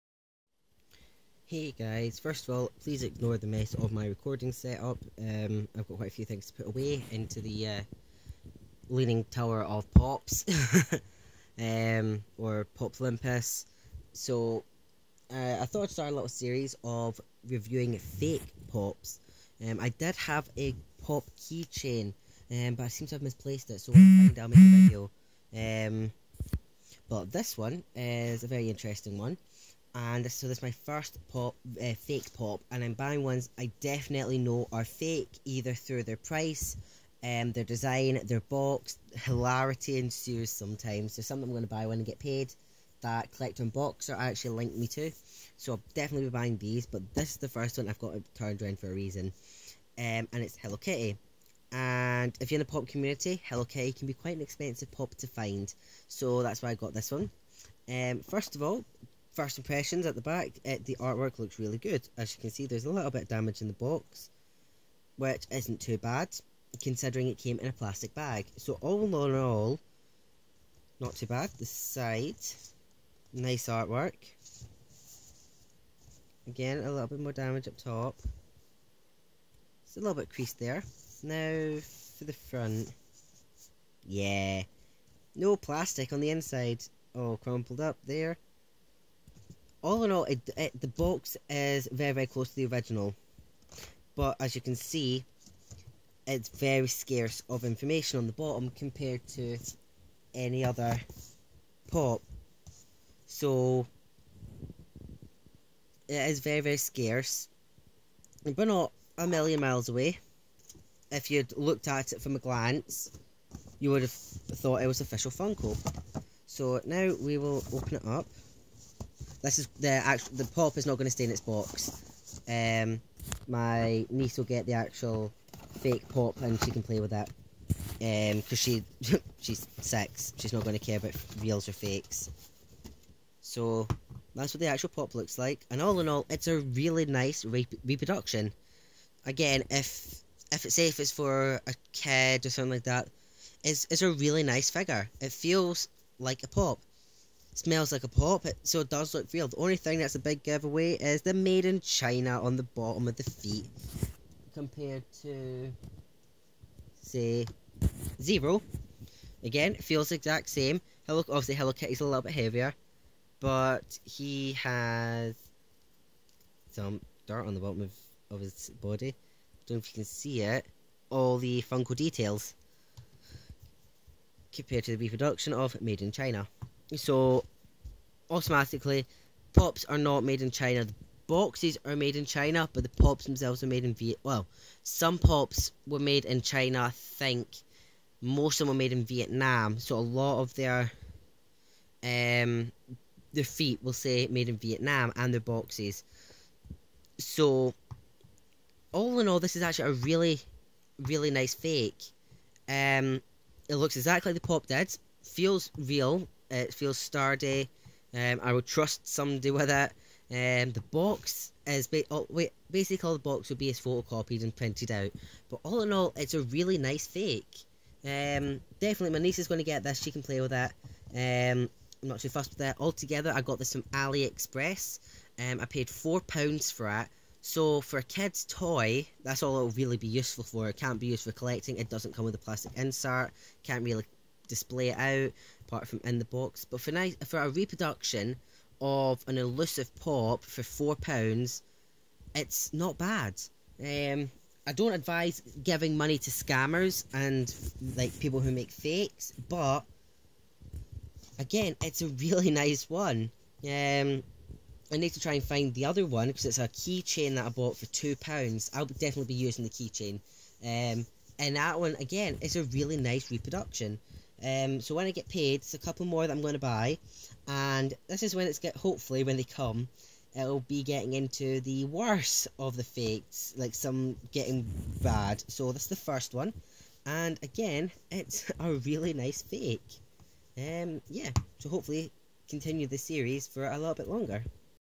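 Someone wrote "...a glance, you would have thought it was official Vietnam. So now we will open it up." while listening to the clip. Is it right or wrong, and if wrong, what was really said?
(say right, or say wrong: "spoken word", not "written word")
wrong: "Funko", not "Vietnam".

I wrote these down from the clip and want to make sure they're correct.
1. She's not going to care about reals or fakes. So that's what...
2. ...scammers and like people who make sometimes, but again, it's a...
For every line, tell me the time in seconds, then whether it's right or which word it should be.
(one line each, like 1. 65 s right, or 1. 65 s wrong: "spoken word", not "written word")
1. 130 s right
2. 246 s wrong: "fakes", not "sometimes".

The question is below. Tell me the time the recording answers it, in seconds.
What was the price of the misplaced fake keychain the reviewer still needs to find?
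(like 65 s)
257 s.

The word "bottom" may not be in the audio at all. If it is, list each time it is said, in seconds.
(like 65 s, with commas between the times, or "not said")
98 s, 152 s, 167 s.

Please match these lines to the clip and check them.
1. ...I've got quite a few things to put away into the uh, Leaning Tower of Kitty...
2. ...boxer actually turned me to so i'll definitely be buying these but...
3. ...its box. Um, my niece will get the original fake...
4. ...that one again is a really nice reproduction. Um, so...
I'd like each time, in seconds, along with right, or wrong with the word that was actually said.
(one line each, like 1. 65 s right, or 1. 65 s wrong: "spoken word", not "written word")
1. 5 s wrong: "Pops", not "Kitty"
2. 43 s wrong: "linked", not "turned"
3. 121 s wrong: "actual", not "original"
4. 261 s right.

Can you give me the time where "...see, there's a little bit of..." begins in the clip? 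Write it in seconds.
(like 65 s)
62 s.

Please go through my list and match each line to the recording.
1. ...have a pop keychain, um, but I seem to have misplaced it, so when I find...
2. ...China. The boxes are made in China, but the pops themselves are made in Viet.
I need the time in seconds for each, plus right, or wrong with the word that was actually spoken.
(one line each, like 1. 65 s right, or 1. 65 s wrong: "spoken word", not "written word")
1. 20 s right
2. 180 s right.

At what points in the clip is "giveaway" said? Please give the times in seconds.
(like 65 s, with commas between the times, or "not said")
150 s.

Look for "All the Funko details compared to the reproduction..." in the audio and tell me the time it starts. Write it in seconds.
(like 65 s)
171 s.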